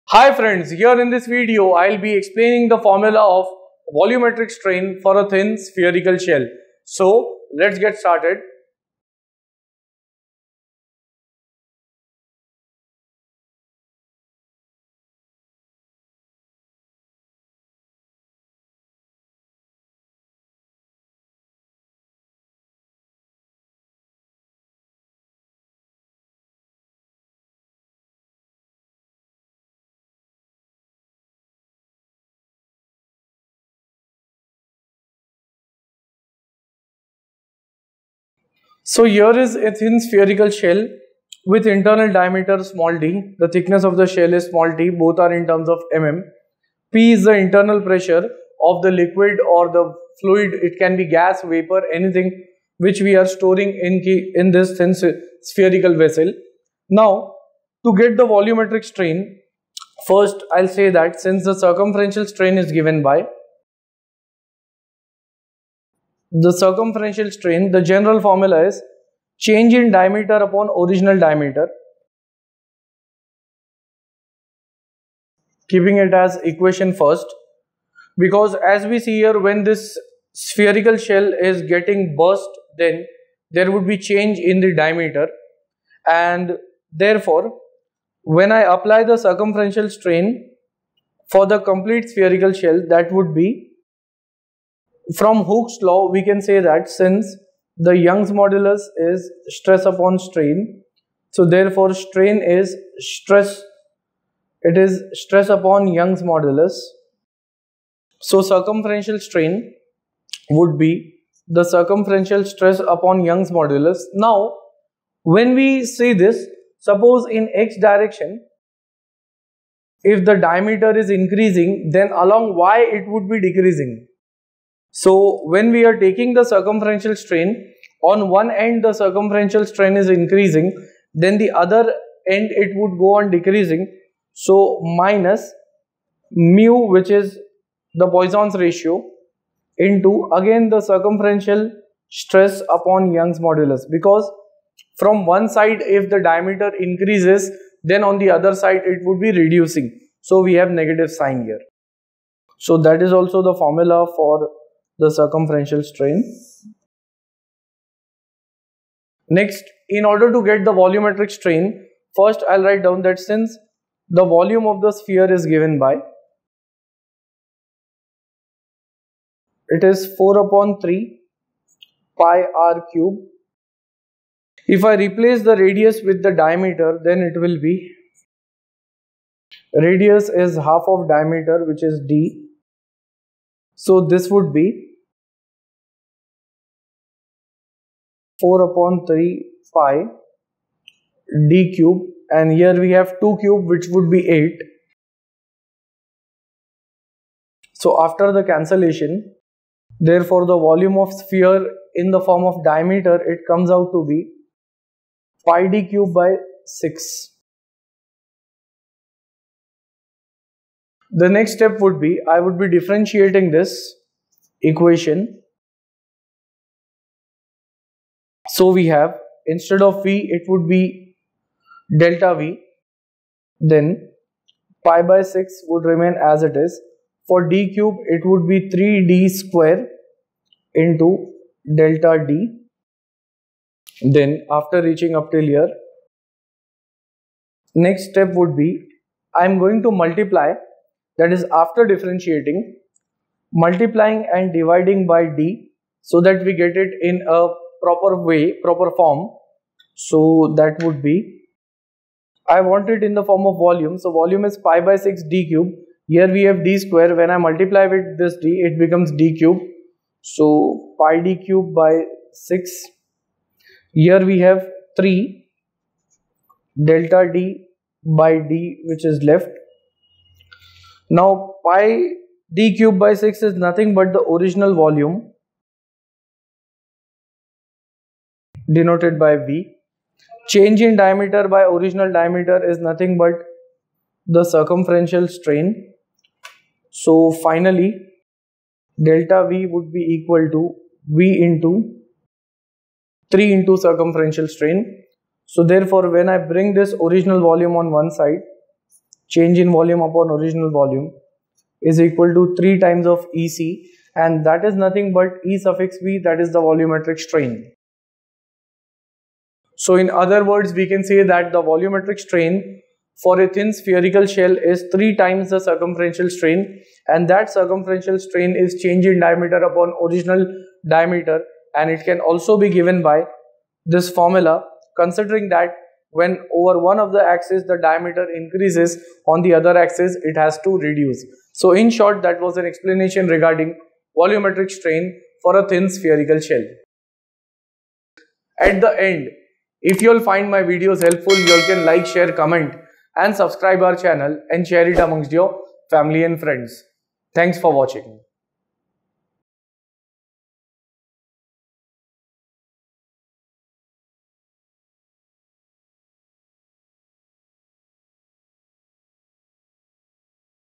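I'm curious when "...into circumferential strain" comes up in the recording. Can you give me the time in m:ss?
4:53.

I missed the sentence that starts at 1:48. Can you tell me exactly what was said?
So circumferential strain would be the circumferential stress upon Young's modulus.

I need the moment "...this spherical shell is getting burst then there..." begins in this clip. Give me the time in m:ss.
1:19.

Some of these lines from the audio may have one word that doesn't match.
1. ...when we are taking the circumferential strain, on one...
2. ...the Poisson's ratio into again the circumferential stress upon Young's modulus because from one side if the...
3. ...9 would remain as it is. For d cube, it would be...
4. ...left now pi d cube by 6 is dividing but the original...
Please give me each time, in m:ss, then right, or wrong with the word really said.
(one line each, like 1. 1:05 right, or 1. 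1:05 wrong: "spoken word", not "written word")
1. 2:05 right
2. 2:17 right
3. 3:45 wrong: "6", not "9"
4. 4:29 wrong: "nothing", not "dividing".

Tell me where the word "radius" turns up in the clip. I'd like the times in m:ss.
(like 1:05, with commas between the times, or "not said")
2:55, 2:59.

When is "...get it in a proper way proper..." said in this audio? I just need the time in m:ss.
4:06.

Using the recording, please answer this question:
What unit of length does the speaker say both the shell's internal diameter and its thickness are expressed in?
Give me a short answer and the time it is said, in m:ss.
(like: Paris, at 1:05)
mm, at 0:45.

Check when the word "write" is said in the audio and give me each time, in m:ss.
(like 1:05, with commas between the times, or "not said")
2:42.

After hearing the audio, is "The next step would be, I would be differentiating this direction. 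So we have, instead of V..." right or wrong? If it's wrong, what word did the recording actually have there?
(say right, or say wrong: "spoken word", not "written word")
wrong: "equation", not "direction".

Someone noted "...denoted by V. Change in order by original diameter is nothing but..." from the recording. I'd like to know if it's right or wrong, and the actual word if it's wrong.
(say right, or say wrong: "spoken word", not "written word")
wrong: "diameter", not "order".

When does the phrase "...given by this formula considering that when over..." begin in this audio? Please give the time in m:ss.
5:22.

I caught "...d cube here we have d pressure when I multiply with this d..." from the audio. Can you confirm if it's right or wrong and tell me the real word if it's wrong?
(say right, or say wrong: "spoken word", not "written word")
wrong: "square", not "pressure".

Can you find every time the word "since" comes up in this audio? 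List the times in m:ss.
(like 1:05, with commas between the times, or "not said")
1:01, 1:36, 2:43.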